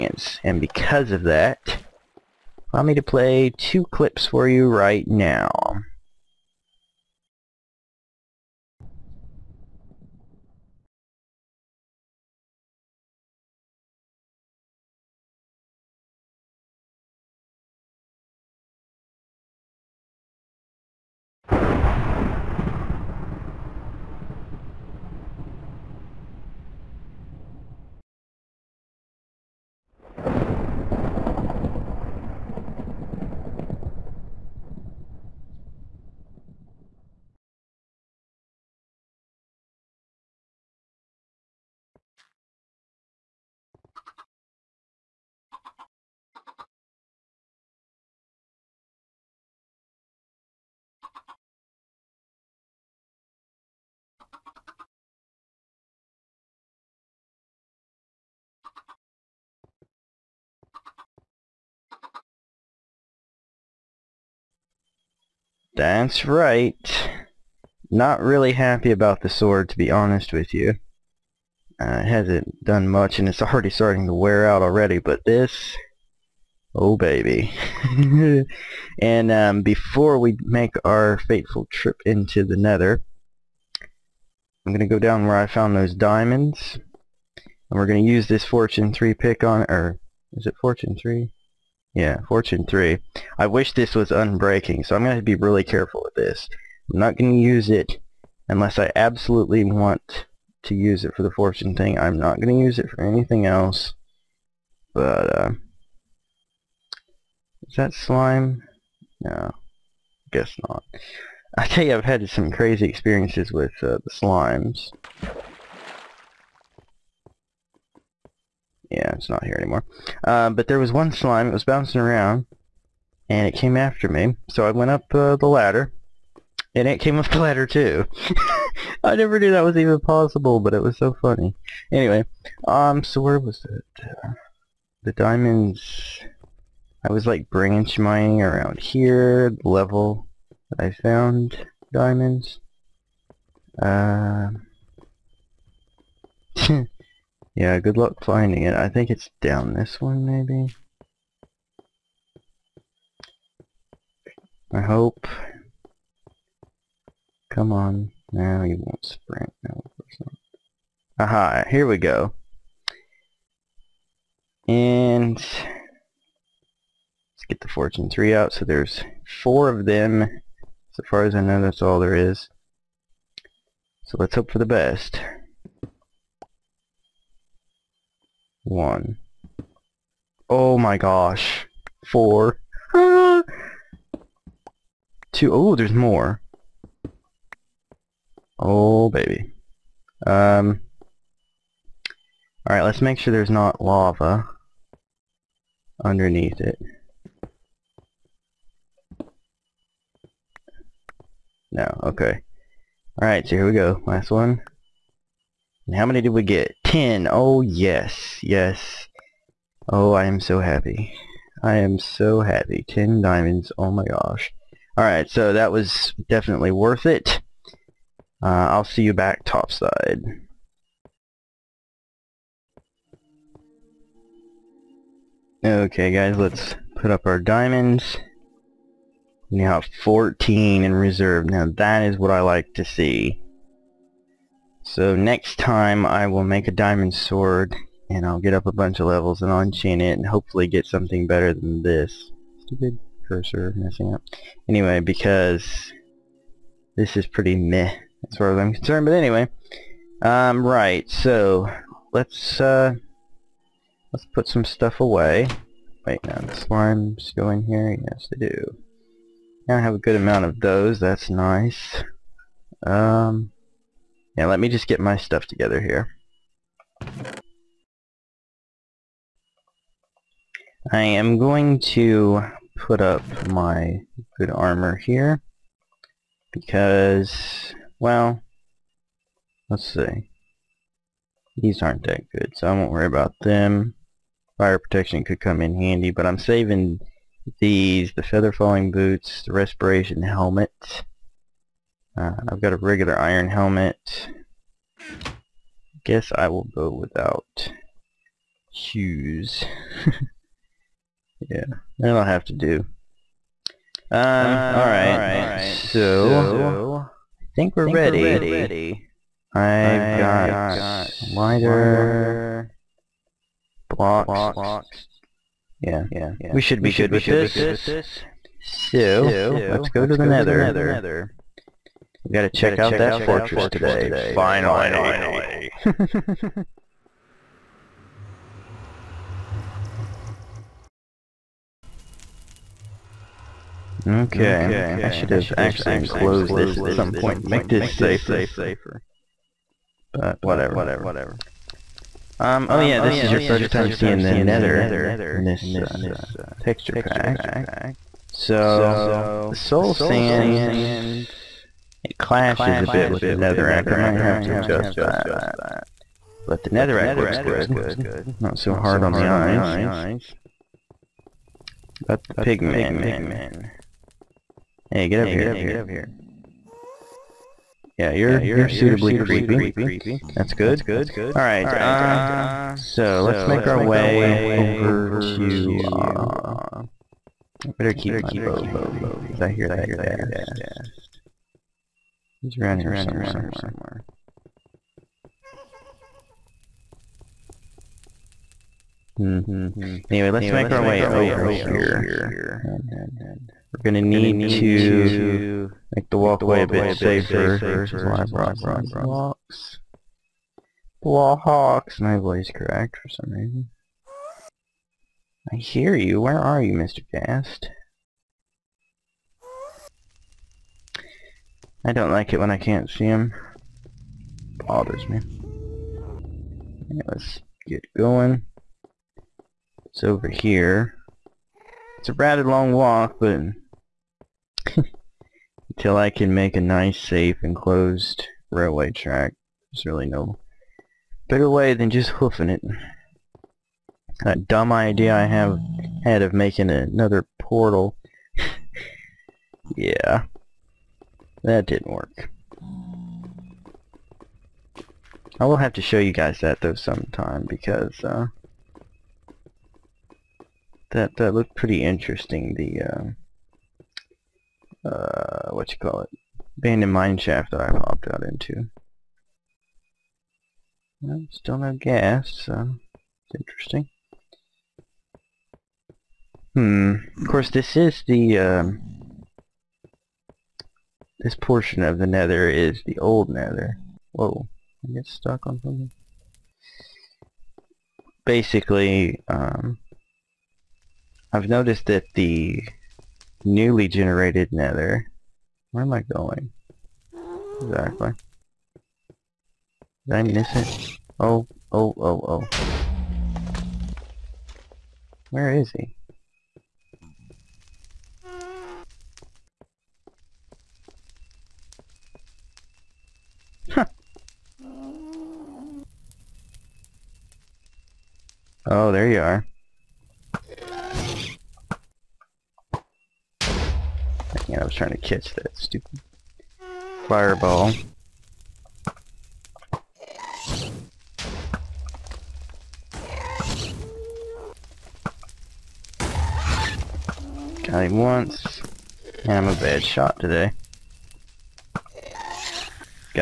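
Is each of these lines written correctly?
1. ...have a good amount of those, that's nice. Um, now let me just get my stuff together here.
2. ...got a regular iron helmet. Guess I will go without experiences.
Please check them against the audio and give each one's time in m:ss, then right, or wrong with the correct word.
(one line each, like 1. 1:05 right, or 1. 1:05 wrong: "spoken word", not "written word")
1. 4:19 right
2. 4:52 wrong: "shoes", not "experiences".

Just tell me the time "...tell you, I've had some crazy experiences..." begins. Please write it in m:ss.
1:51.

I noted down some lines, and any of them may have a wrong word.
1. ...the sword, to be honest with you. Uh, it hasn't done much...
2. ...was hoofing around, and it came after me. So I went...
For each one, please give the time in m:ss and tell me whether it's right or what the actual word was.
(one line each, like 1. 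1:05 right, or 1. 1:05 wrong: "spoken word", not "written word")
1. 1:09 right
2. 2:01 wrong: "bouncing", not "hoofing".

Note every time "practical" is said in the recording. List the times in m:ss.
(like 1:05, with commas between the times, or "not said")
not said.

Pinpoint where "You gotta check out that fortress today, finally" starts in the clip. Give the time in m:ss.
5:22.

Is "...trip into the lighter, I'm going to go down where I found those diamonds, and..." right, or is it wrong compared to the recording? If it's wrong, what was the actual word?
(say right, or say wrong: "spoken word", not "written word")
wrong: "nether", not "lighter".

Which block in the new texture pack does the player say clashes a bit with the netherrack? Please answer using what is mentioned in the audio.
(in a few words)
soul sand.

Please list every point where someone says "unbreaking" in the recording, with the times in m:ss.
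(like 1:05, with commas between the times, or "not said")
1:34.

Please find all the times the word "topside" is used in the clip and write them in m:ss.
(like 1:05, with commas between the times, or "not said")
3:39.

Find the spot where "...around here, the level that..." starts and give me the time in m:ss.
2:18.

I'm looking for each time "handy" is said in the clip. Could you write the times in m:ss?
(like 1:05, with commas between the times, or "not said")
4:45, 6:18.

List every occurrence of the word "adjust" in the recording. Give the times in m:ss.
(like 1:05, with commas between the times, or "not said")
5:54.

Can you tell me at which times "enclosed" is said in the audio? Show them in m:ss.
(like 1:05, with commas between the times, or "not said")
5:35, 7:07.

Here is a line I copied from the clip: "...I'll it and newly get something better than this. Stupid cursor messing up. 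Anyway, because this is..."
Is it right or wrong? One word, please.
wrong.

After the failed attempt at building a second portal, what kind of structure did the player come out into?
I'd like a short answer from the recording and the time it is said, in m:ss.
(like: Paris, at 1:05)
abandoned mine shaft, at 7:36.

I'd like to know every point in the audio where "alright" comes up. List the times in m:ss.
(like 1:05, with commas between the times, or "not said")
3:12, 3:23, 3:34, 5:04, 6:11.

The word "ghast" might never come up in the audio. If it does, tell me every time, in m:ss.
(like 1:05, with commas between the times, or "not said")
6:19, 6:47, 7:41.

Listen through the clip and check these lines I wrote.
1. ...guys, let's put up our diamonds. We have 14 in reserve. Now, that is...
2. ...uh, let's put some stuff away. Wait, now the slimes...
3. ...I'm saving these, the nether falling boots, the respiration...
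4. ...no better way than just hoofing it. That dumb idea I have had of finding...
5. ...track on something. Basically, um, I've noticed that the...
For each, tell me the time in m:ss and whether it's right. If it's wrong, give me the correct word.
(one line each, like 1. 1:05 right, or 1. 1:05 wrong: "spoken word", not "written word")
1. 3:46 right
2. 4:12 right
3. 4:46 wrong: "feather", not "nether"
4. 7:10 wrong: "making", not "finding"
5. 7:55 wrong: "stuck", not "track".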